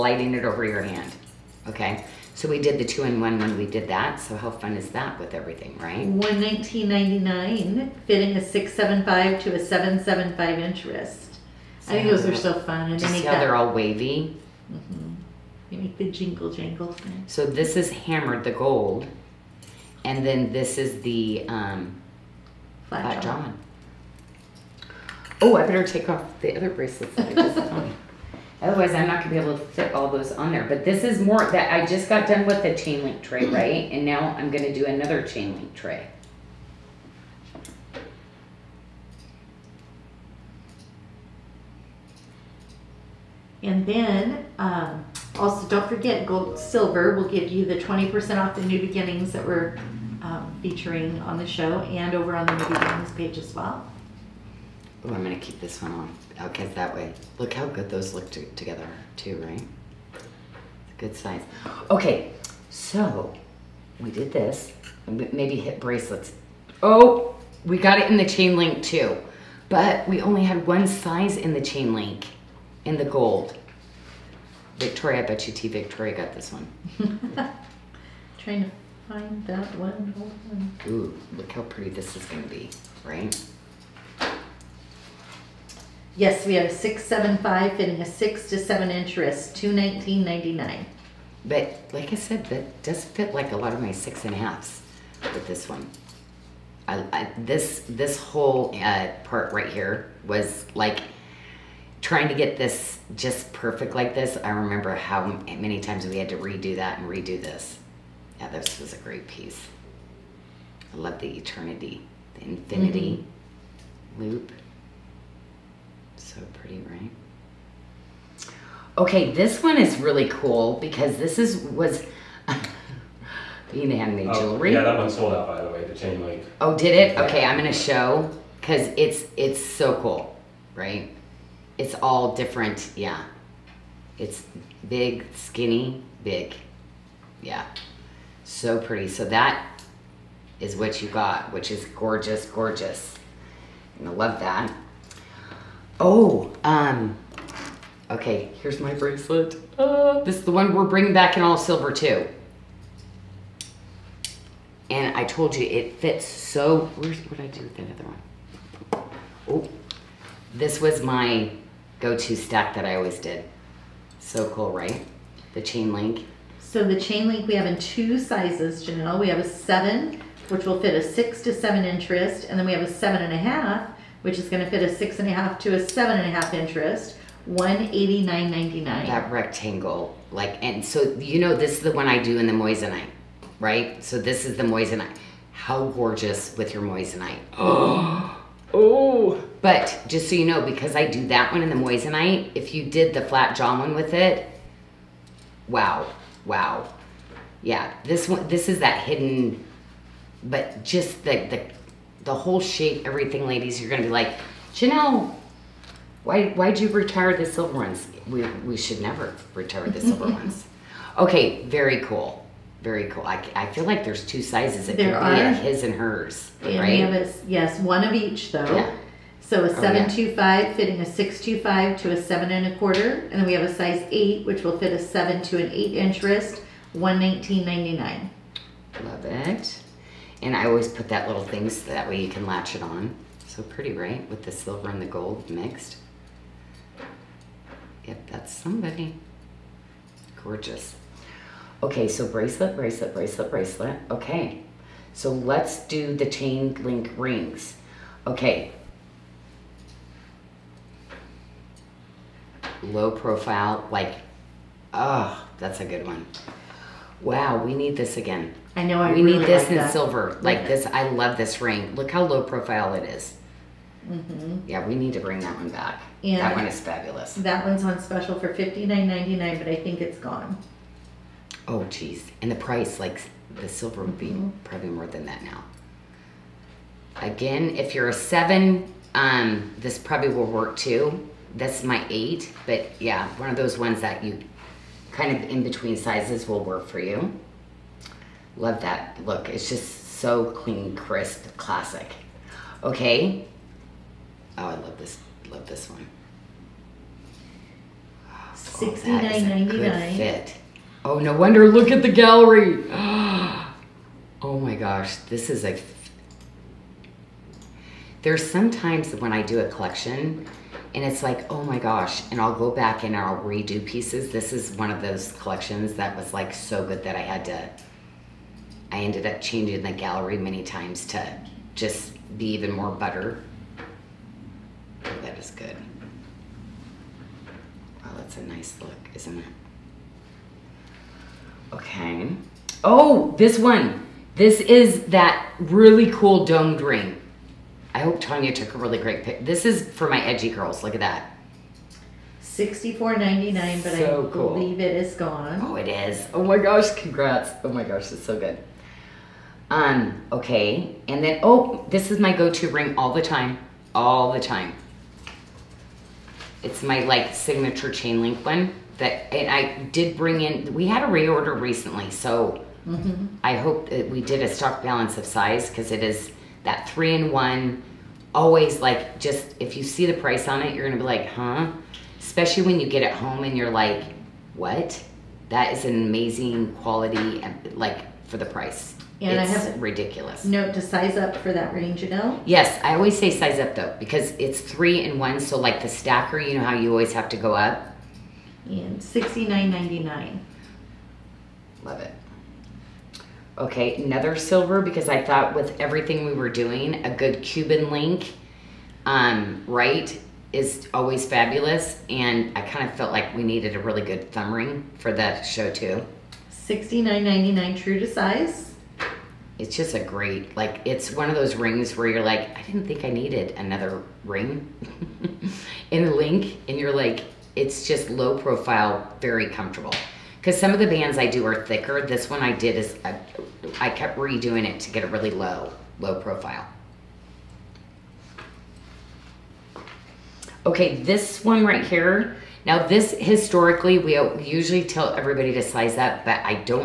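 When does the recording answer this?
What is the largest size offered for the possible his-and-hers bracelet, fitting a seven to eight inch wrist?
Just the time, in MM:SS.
03:43.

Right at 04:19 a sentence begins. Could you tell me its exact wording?
I we really need this like in that.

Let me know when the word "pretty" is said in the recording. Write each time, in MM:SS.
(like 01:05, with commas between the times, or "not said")
01:21, 01:56, 02:18, 03:53.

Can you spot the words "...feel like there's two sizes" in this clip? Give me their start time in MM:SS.
03:33.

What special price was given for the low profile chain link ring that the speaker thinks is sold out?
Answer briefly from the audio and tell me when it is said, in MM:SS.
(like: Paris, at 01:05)
$59.99, at 04:28.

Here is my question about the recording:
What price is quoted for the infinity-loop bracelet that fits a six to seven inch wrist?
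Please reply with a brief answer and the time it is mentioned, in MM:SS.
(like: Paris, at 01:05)
$219.99, at 01:29.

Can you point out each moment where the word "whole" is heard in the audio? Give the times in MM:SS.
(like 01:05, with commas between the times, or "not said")
01:38, 03:22.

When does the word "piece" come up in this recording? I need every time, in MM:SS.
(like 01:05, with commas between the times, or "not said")
01:49, 05:13.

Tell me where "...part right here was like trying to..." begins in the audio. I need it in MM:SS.
01:39.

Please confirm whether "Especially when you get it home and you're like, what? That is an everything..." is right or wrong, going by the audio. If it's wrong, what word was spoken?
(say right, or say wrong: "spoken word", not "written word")
wrong: "amazing", not "everything".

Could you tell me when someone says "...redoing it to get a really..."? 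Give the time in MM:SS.
07:04.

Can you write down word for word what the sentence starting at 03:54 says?
With the silver and the gold mixed.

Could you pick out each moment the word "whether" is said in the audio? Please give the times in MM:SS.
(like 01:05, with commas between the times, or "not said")
not said.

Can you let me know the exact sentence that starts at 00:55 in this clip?
Ooh, I'm gonna keep this one on, Okay, that way, look how good those look to, together too, right?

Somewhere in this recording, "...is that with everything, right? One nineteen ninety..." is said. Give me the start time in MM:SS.
00:04.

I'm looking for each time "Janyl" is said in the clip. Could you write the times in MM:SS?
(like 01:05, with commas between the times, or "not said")
02:48, 03:24, 06:22.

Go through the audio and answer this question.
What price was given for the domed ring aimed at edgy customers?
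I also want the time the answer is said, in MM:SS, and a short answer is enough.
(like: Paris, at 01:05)
$64.99, at 05:42.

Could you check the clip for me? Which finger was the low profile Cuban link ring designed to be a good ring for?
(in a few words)
Thumb.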